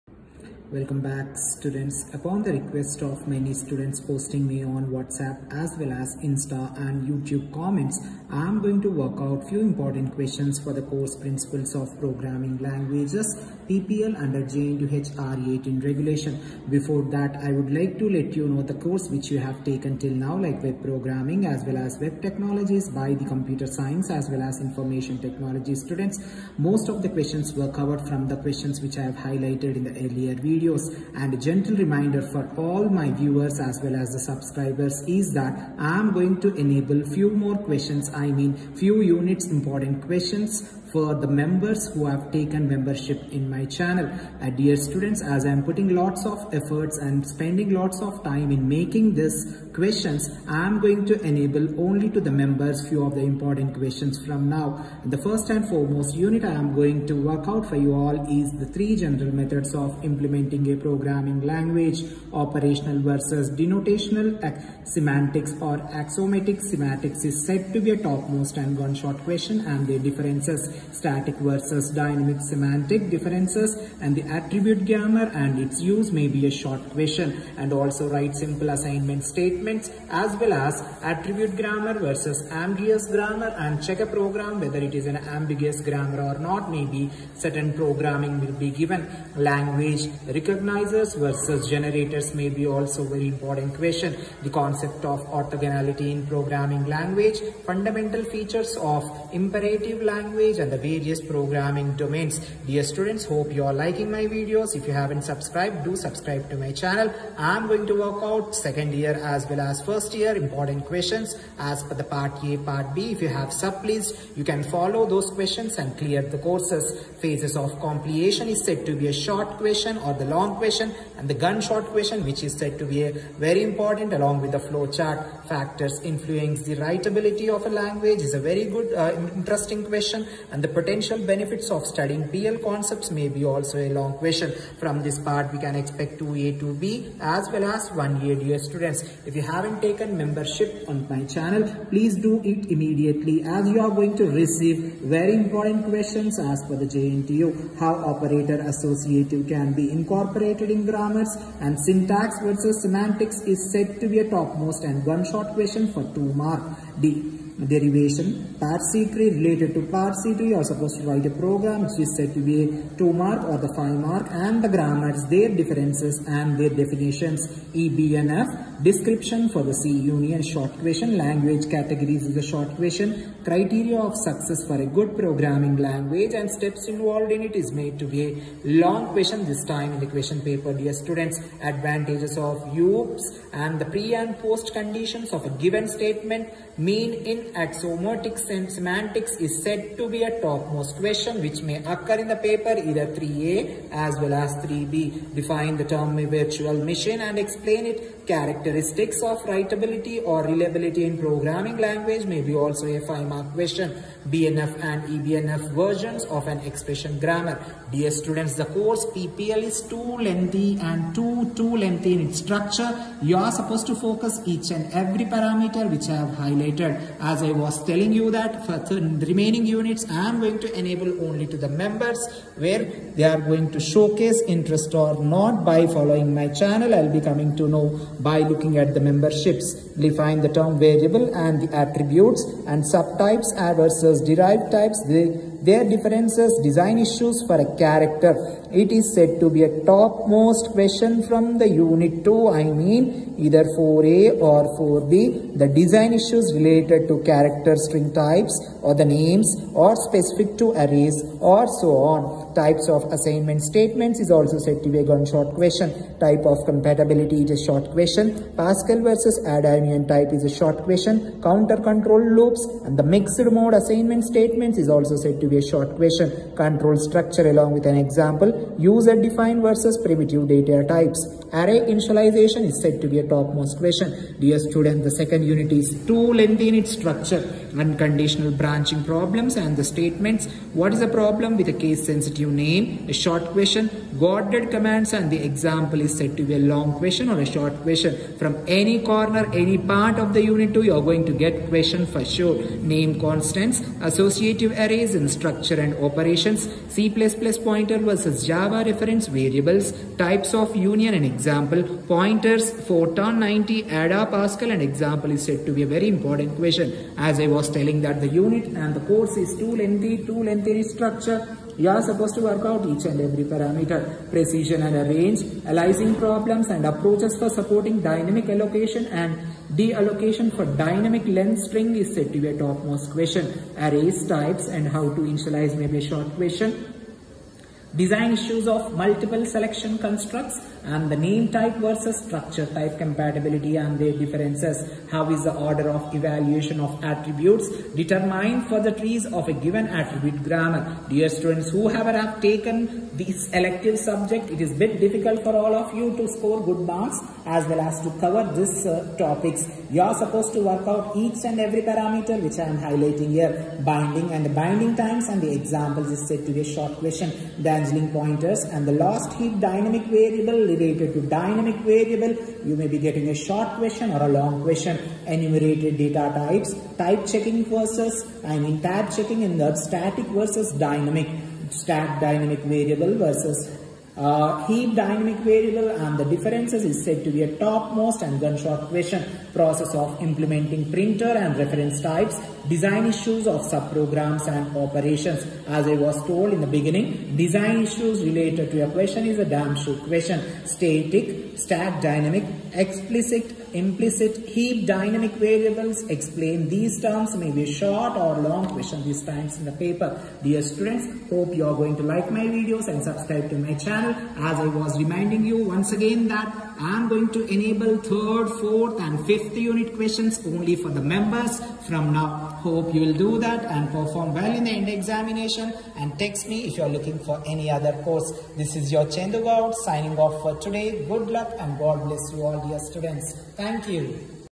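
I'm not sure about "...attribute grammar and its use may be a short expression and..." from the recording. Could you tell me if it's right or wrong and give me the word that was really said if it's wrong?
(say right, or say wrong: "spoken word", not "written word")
wrong: "question", not "expression".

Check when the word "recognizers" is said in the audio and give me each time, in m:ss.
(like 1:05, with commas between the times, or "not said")
1:30.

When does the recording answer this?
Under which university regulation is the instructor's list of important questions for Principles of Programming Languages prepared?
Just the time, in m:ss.
0:14.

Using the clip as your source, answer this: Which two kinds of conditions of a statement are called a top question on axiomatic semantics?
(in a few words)
pre and post conditions.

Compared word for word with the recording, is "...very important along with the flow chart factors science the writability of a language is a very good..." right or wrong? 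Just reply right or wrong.
wrong.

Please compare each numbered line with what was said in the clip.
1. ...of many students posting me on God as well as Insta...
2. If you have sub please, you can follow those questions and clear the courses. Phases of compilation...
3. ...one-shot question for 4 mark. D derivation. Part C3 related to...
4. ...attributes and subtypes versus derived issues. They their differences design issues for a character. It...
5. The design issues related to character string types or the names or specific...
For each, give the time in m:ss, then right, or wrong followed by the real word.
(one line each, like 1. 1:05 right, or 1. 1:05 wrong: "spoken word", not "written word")
1. 0:03 wrong: "WhatsApp", not "God"
2. 1:53 right
3. 2:35 wrong: "2", not "4"
4. 3:51 wrong: "types", not "issues"
5. 4:05 right.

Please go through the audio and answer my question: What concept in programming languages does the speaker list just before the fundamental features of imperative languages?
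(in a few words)
orthogonality.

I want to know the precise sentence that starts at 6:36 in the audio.
Explain these terms, maybe short or long question these times in the paper.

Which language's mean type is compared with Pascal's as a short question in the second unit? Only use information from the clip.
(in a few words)
Ada.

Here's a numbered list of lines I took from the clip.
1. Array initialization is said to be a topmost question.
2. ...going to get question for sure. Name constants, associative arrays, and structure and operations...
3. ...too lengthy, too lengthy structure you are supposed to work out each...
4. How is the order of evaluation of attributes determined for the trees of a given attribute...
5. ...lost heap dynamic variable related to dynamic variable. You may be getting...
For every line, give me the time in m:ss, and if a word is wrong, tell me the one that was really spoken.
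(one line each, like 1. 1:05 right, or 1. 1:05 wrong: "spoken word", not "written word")
1. 4:31 right
2. 4:51 right
3. 5:09 right
4. 5:35 right
5. 5:58 right.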